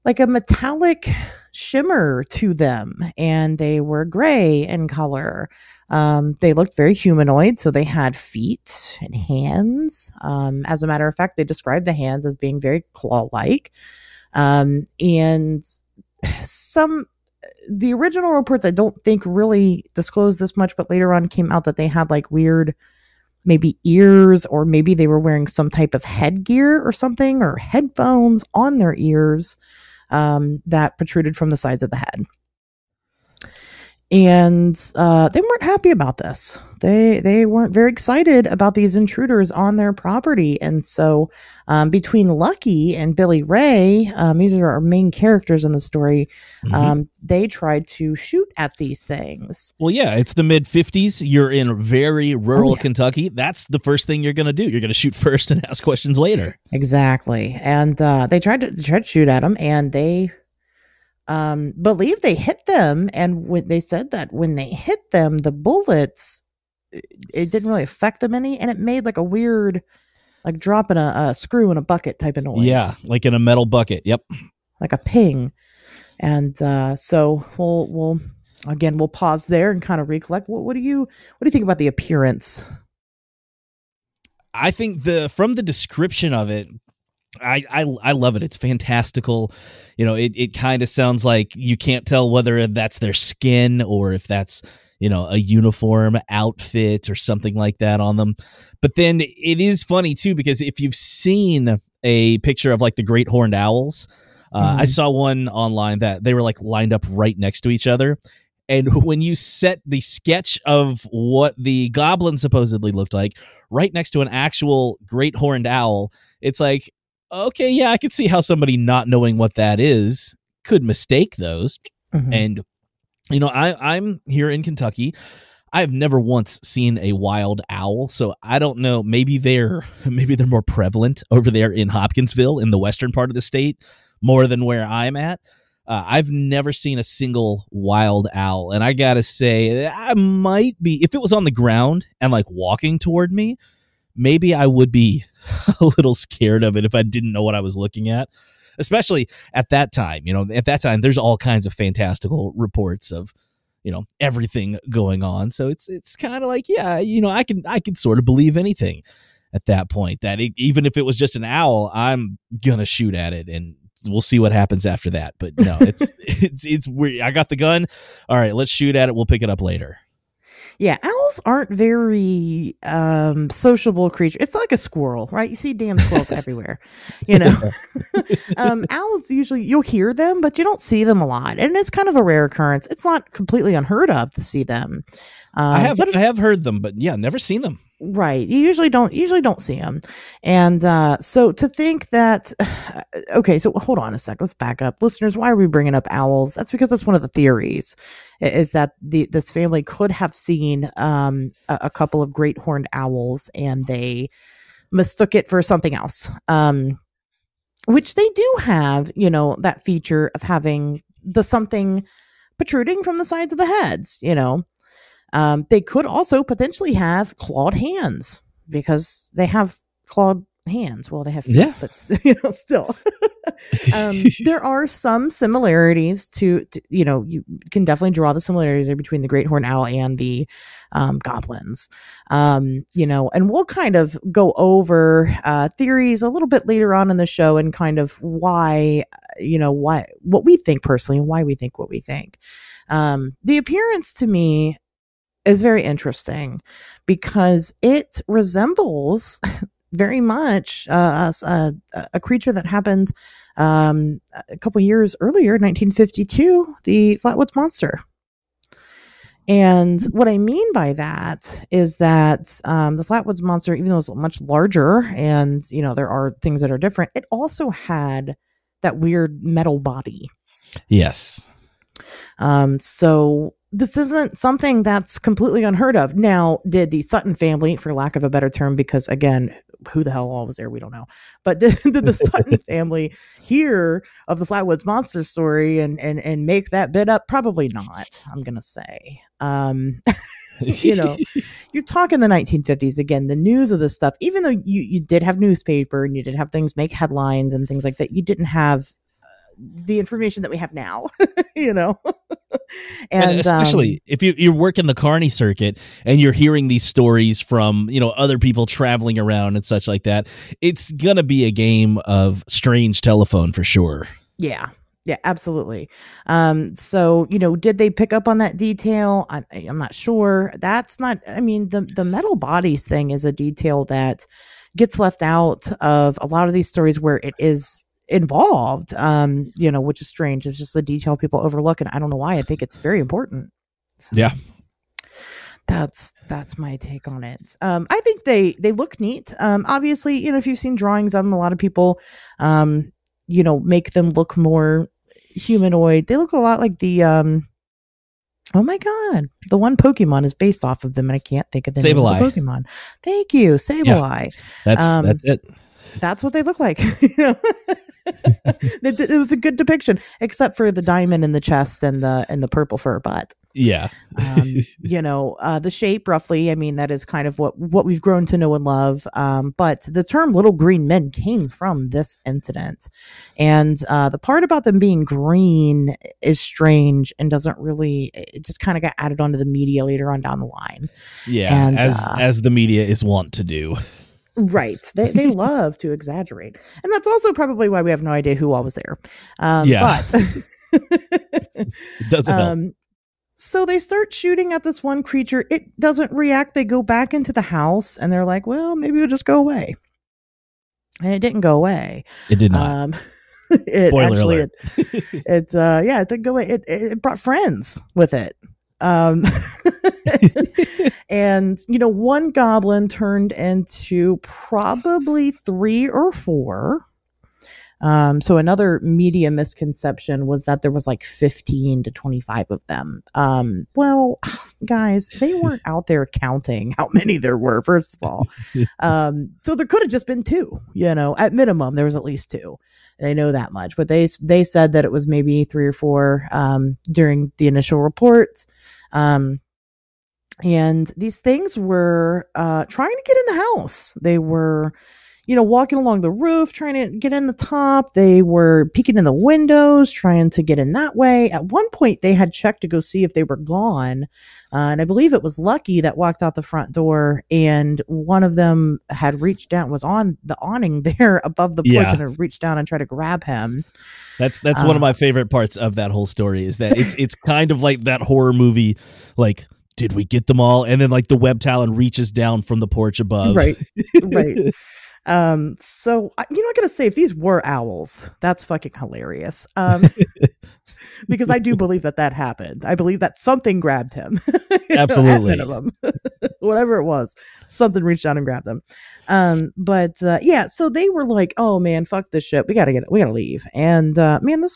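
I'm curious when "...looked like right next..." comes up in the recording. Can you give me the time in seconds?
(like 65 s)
112 s.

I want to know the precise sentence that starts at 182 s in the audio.
It's not completely unheard of to see them.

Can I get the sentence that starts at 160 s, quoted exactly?
That it, even if it was just an owl, I'm gonna shoot at it and we'll see what happens after that.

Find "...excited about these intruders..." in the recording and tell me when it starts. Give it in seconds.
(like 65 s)
37 s.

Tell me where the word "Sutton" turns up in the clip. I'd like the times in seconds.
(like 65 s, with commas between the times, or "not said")
277 s, 282 s.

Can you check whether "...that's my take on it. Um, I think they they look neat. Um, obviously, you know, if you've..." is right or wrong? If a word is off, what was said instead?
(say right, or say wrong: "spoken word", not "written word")
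right.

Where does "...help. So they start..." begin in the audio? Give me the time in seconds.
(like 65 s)
392 s.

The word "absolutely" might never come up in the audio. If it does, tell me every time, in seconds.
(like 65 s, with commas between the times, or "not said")
315 s, 484 s.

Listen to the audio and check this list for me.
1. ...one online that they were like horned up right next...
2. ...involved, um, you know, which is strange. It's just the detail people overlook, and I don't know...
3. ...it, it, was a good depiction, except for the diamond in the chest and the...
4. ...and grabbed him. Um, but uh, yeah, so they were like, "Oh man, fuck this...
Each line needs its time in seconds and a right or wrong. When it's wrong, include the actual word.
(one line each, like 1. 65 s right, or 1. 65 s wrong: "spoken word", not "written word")
1. 105 s wrong: "lined", not "horned"
2. 328 s right
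3. 358 s right
4. 488 s right.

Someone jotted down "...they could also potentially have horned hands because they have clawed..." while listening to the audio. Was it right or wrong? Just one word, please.
wrong.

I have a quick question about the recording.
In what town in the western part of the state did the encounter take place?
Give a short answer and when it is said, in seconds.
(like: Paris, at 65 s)
Hopkinsville, at 131 s.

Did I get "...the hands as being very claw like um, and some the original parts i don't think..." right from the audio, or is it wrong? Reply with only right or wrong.
wrong.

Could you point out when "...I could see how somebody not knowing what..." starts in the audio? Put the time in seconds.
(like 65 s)
117 s.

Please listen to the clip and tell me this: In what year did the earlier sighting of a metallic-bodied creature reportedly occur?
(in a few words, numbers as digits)
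1952.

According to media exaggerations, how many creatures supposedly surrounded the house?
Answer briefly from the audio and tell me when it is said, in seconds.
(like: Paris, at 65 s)
15 to 25, at 421 s.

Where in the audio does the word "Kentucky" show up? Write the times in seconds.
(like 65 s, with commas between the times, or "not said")
52 s, 124 s.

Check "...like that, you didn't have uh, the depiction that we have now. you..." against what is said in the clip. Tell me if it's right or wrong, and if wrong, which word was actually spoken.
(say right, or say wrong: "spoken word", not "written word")
wrong: "information", not "depiction".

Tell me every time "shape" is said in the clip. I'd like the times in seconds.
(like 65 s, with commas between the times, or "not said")
365 s.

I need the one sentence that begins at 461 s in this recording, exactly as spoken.
and had reached down and tried to grab him.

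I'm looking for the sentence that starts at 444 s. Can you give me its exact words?
They were, you know, walking along the roof, trying to get in the top.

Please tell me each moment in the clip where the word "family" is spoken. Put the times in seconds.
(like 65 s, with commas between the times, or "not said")
199 s, 277 s, 282 s.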